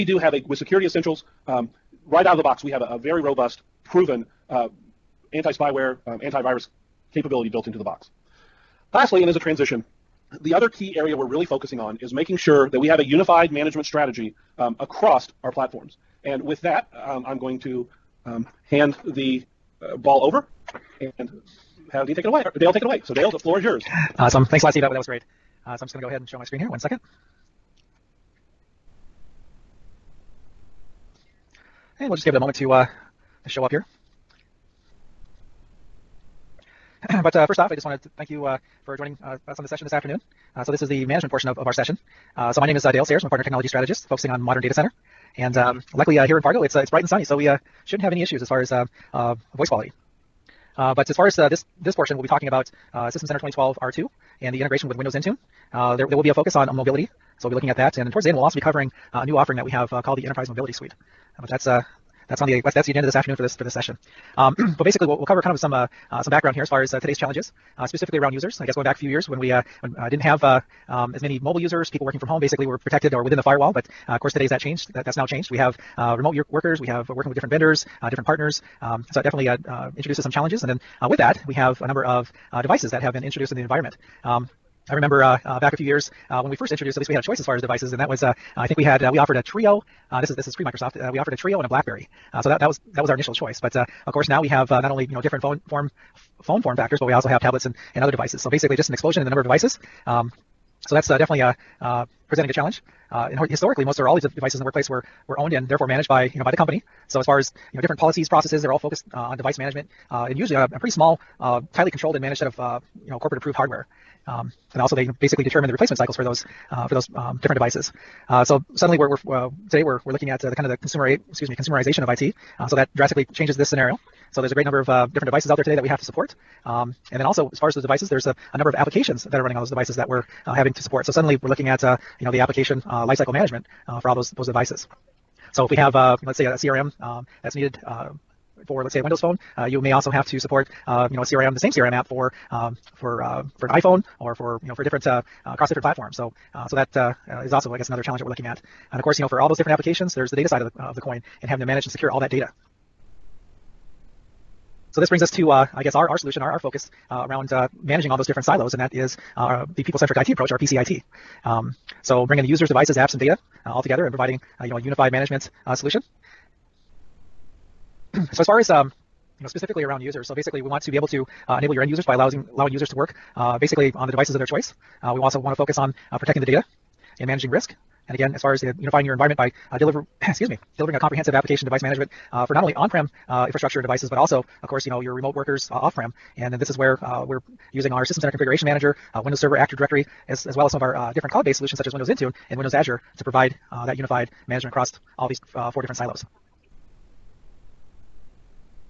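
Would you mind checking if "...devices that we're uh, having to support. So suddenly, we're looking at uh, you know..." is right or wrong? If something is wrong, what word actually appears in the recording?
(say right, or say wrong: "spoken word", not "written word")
right.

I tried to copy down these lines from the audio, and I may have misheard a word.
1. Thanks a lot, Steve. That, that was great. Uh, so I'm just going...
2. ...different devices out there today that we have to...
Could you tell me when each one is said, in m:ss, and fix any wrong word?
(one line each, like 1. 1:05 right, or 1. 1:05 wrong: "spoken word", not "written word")
1. 0:24 right
2. 2:05 right.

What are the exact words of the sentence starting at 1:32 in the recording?
so that that was that was our initial choice.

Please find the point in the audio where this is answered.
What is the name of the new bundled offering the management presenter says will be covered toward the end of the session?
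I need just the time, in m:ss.
1:00.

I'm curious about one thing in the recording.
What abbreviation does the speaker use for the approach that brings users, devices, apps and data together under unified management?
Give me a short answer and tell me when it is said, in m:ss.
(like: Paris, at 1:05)
PCIT, at 2:40.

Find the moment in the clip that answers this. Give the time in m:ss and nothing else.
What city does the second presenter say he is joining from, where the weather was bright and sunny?
0:46.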